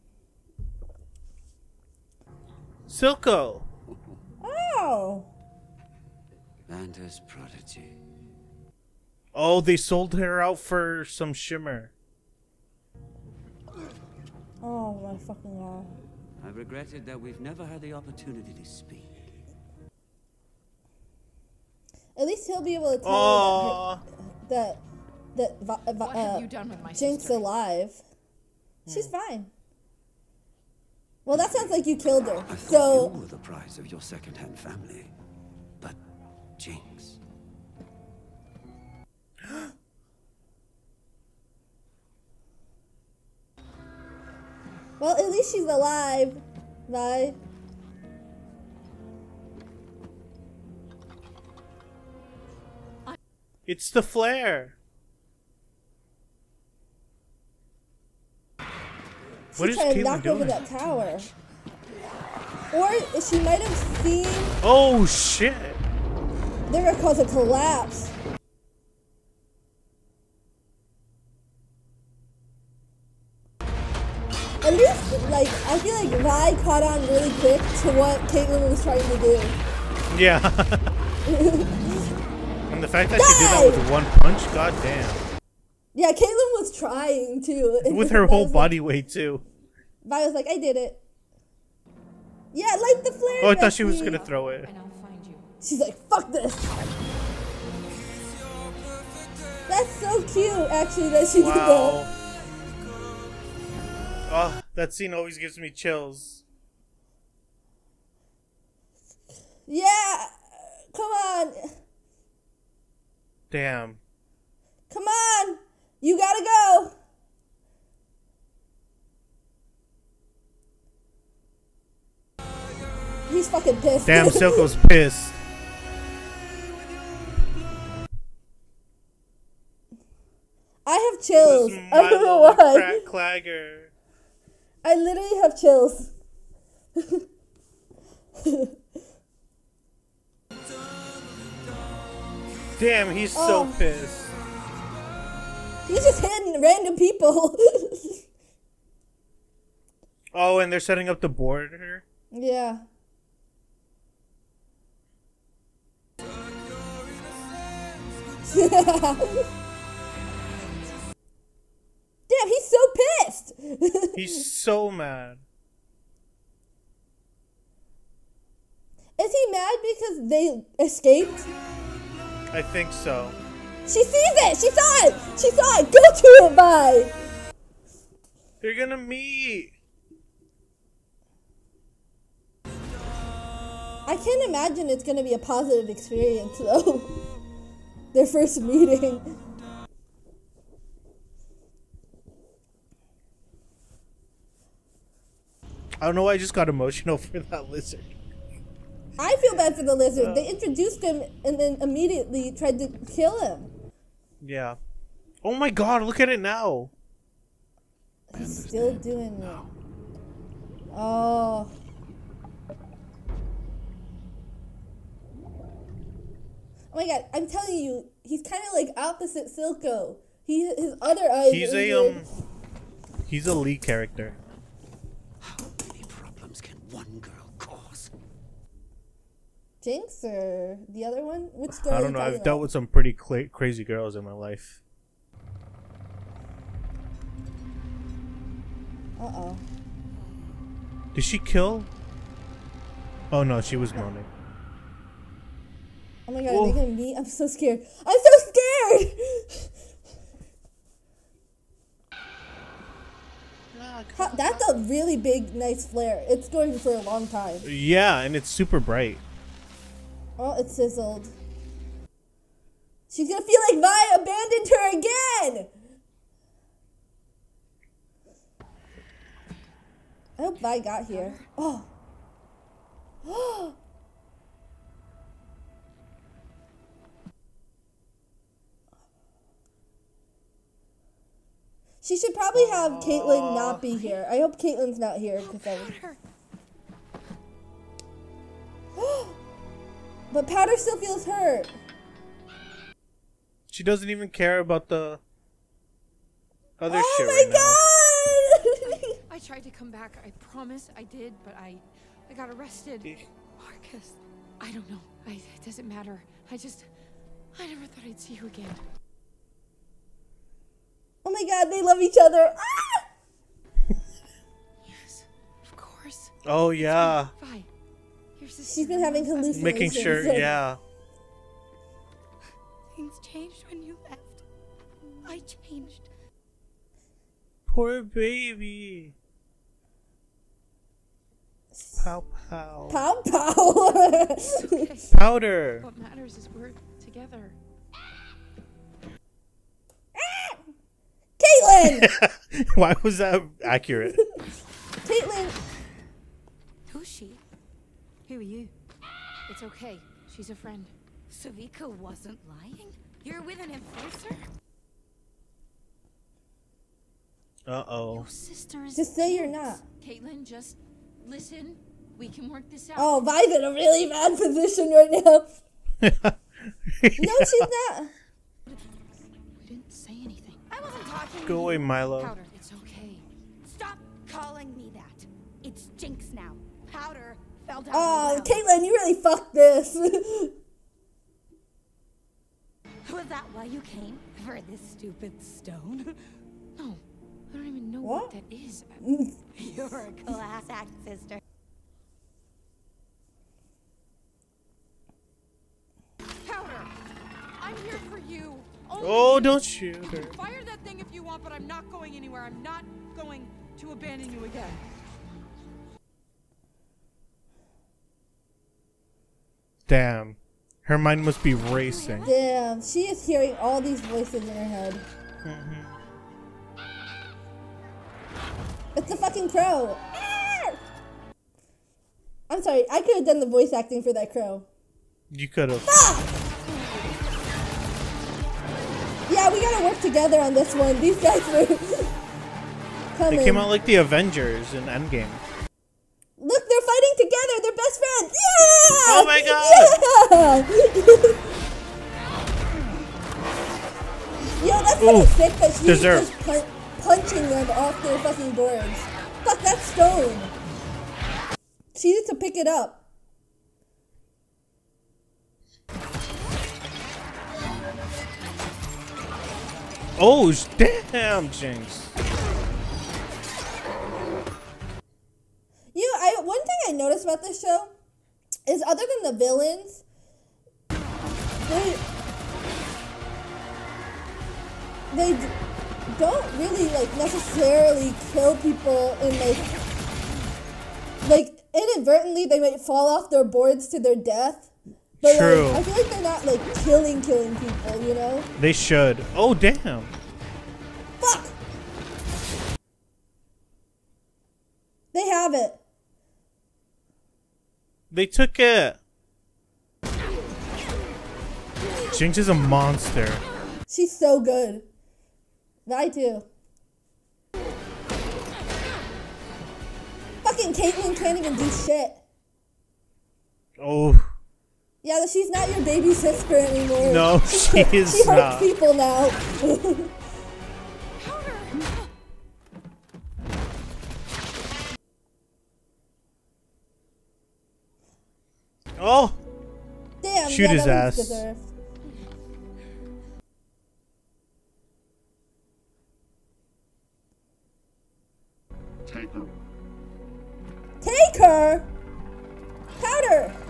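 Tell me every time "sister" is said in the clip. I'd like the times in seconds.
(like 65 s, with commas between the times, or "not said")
27 s, 358 s, 391 s, 516 s.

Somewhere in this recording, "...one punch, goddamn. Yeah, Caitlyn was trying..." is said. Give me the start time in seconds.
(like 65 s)
83 s.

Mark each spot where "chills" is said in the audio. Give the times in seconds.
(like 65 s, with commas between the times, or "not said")
105 s, 131 s, 135 s.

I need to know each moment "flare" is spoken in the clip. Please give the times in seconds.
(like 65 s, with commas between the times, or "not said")
54 s, 93 s, 255 s.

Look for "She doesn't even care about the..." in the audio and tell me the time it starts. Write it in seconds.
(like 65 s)
293 s.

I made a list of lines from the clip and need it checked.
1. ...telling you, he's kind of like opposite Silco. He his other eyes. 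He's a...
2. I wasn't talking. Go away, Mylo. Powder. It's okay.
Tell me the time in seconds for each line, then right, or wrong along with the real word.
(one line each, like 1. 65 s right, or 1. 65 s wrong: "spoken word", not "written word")
1. 217 s right
2. 370 s right.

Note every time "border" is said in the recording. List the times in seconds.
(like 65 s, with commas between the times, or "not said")
151 s.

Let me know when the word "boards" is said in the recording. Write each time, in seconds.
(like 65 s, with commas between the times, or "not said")
448 s, 483 s.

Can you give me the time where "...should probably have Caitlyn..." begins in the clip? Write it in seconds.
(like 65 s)
282 s.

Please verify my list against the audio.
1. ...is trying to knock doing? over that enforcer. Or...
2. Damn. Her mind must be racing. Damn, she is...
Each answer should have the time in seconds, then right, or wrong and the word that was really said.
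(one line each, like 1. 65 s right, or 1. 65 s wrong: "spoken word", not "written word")
1. 59 s wrong: "tower", not "enforcer"
2. 409 s right.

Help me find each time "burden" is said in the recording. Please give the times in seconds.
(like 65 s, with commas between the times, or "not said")
not said.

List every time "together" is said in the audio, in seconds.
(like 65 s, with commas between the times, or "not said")
337 s, 430 s, 437 s.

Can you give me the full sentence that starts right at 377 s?
Oh, Caitlyn, you really fucked this.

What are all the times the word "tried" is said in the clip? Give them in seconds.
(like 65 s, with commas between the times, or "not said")
202 s, 299 s.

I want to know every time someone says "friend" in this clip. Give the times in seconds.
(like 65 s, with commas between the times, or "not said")
350 s, 438 s.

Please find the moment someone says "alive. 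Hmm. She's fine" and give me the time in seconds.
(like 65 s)
27 s.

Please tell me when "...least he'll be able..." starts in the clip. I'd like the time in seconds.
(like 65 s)
22 s.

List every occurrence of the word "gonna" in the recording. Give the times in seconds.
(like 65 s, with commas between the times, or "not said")
66 s, 94 s, 178 s, 185 s, 246 s, 263 s.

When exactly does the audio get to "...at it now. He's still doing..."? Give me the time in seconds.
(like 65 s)
206 s.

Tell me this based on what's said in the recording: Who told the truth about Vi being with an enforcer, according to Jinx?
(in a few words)
Sevika.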